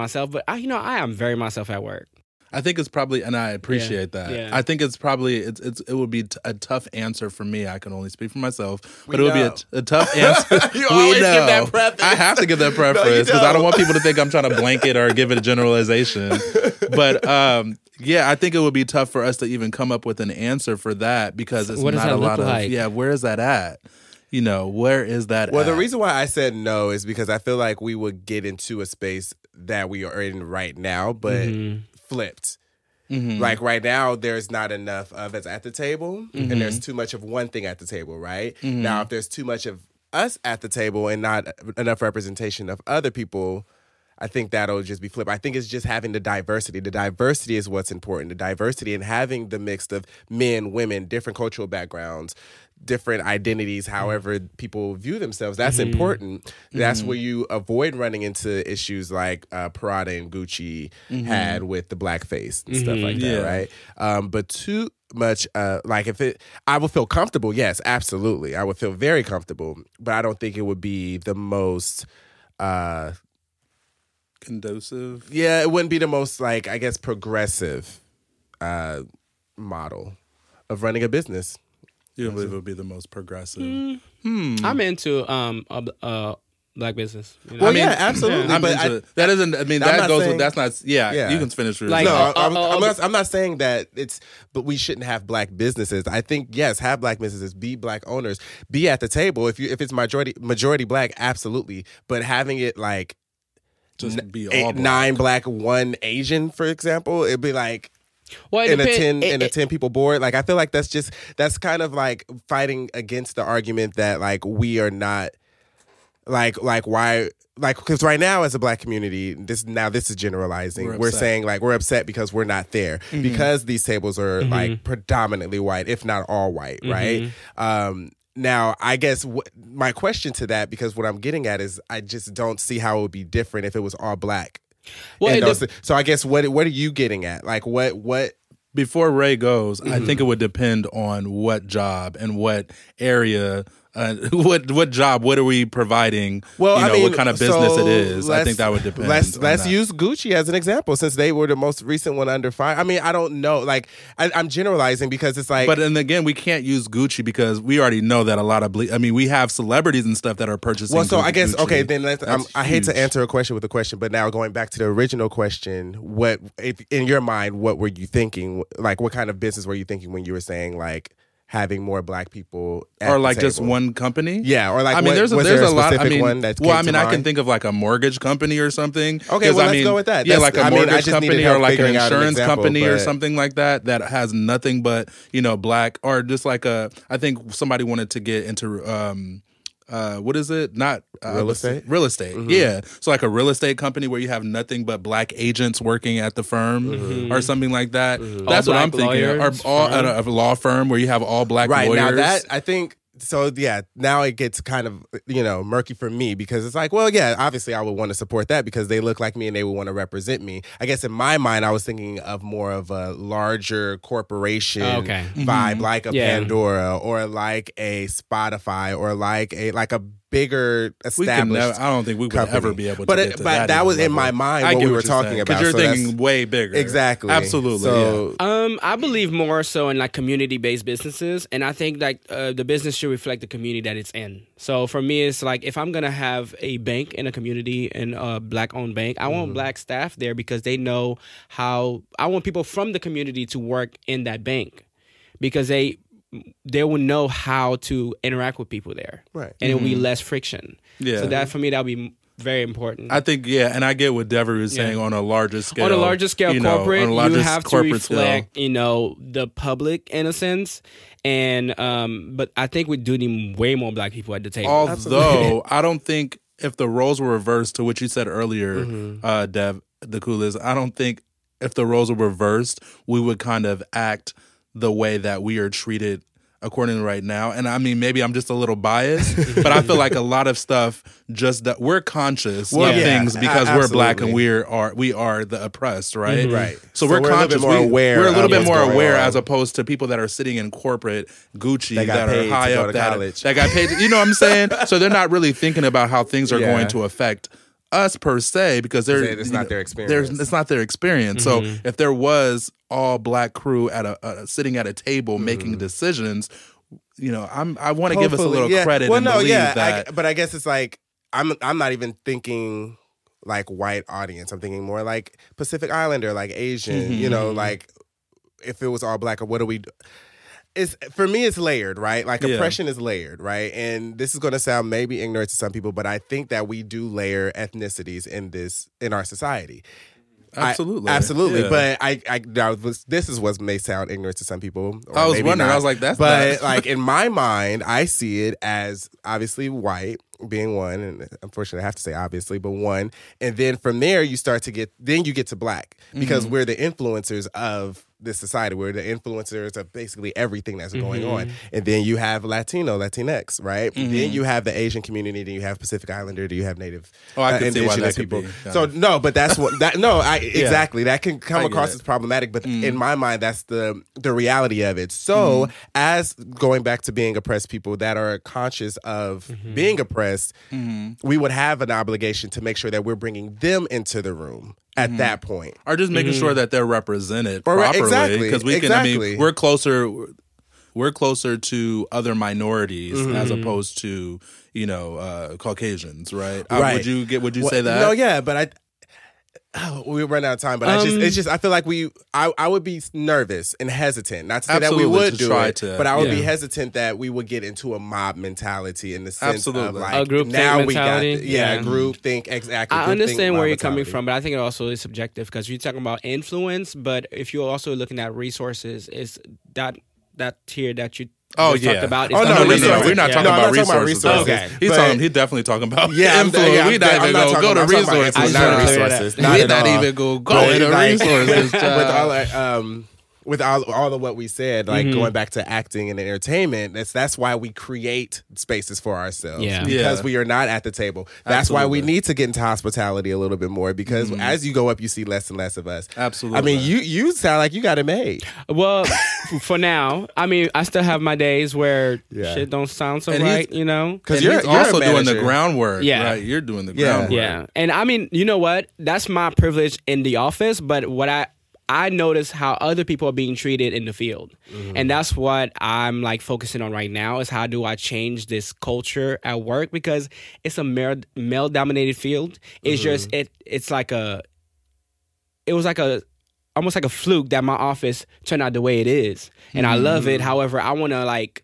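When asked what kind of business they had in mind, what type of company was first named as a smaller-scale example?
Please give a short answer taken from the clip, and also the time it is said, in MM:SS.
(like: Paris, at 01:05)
A mortgage company, at 02:57.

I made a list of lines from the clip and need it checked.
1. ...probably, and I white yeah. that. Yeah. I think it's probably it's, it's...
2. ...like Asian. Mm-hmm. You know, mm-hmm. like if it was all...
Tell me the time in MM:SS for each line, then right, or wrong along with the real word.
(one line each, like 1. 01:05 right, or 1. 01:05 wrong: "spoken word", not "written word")
1. 00:02 wrong: "appreciate", not "white"
2. 05:16 right.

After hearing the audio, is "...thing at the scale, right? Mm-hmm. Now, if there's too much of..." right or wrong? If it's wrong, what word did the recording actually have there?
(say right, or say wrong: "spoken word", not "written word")
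wrong: "table", not "scale".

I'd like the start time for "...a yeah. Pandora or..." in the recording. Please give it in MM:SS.
03:36.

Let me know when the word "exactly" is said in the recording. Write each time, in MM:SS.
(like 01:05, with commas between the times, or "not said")
03:46, 06:00, 06:18, 06:42.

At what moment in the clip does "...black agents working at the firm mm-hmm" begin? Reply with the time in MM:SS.
03:15.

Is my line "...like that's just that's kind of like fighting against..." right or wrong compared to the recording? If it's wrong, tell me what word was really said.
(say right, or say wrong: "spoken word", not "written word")
right.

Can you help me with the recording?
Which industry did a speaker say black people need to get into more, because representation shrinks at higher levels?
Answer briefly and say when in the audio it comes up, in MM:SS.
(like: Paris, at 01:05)
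Hospitality, at 07:12.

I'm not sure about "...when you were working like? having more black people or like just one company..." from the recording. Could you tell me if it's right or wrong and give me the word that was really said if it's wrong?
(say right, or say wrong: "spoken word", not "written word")
wrong: "saying", not "working".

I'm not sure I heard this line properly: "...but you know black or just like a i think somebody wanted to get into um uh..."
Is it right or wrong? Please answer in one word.
right.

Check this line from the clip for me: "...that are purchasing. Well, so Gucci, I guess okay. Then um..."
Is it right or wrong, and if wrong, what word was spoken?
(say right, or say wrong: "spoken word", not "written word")
right.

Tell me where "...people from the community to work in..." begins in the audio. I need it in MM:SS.
04:02.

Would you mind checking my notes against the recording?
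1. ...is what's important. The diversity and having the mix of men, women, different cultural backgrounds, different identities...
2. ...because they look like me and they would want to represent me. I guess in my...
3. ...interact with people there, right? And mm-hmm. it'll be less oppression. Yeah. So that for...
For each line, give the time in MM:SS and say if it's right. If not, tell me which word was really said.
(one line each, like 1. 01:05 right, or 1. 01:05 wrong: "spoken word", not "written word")
1. 00:47 right
2. 03:28 right
3. 04:08 wrong: "friction", not "oppression".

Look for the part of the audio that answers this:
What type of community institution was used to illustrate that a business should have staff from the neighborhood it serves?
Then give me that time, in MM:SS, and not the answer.
03:56.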